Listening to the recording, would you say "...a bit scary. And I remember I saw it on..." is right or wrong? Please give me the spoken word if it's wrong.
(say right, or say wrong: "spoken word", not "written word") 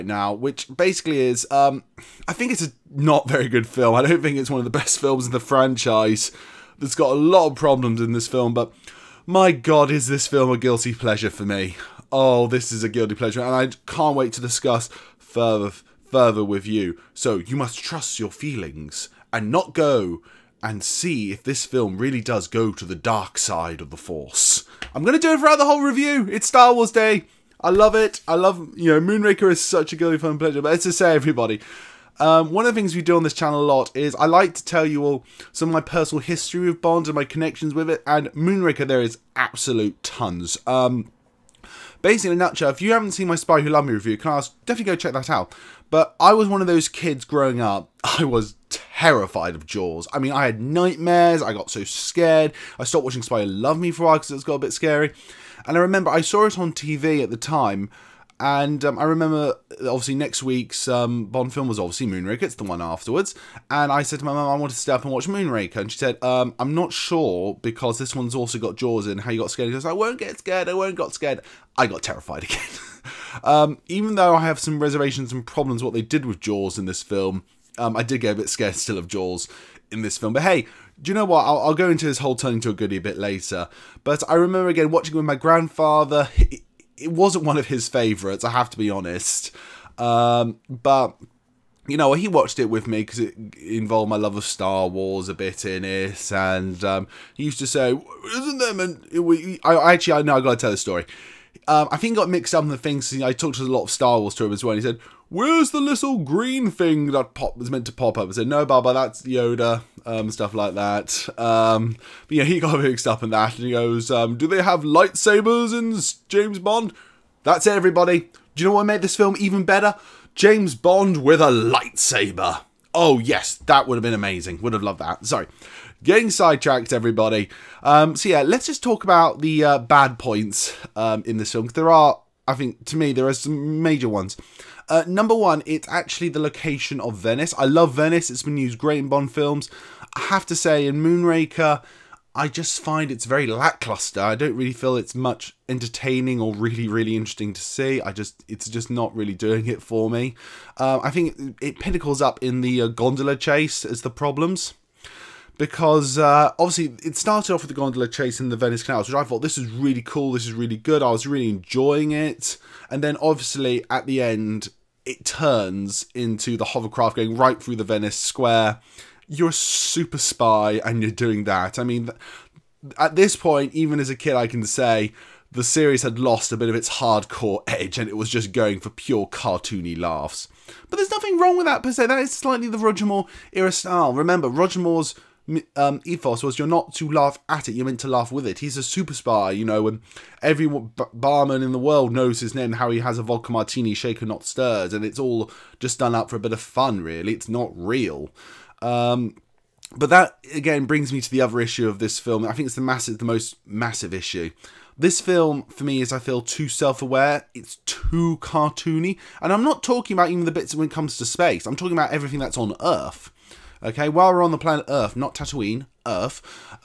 right.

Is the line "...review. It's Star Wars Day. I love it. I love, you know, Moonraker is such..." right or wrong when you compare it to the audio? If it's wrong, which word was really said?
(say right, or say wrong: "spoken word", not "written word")
right.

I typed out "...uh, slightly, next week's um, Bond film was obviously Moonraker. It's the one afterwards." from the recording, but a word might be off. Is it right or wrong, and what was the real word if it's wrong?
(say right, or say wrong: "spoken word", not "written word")
wrong: "obviously", not "slightly".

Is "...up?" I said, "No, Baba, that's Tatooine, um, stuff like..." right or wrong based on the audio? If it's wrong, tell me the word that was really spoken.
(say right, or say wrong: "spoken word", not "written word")
wrong: "Yoda", not "Tatooine".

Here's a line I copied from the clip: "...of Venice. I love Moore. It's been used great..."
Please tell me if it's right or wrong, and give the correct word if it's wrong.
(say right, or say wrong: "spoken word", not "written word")
wrong: "Venice", not "Moore".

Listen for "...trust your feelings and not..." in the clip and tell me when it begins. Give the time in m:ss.
0:17.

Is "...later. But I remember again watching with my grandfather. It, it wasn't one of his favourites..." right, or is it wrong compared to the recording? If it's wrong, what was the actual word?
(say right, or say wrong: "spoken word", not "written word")
right.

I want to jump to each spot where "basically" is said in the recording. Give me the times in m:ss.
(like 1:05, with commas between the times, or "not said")
0:00, 0:42.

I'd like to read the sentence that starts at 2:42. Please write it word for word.
And then obviously at the end, it turns into the hovercraft going right through the Venice square.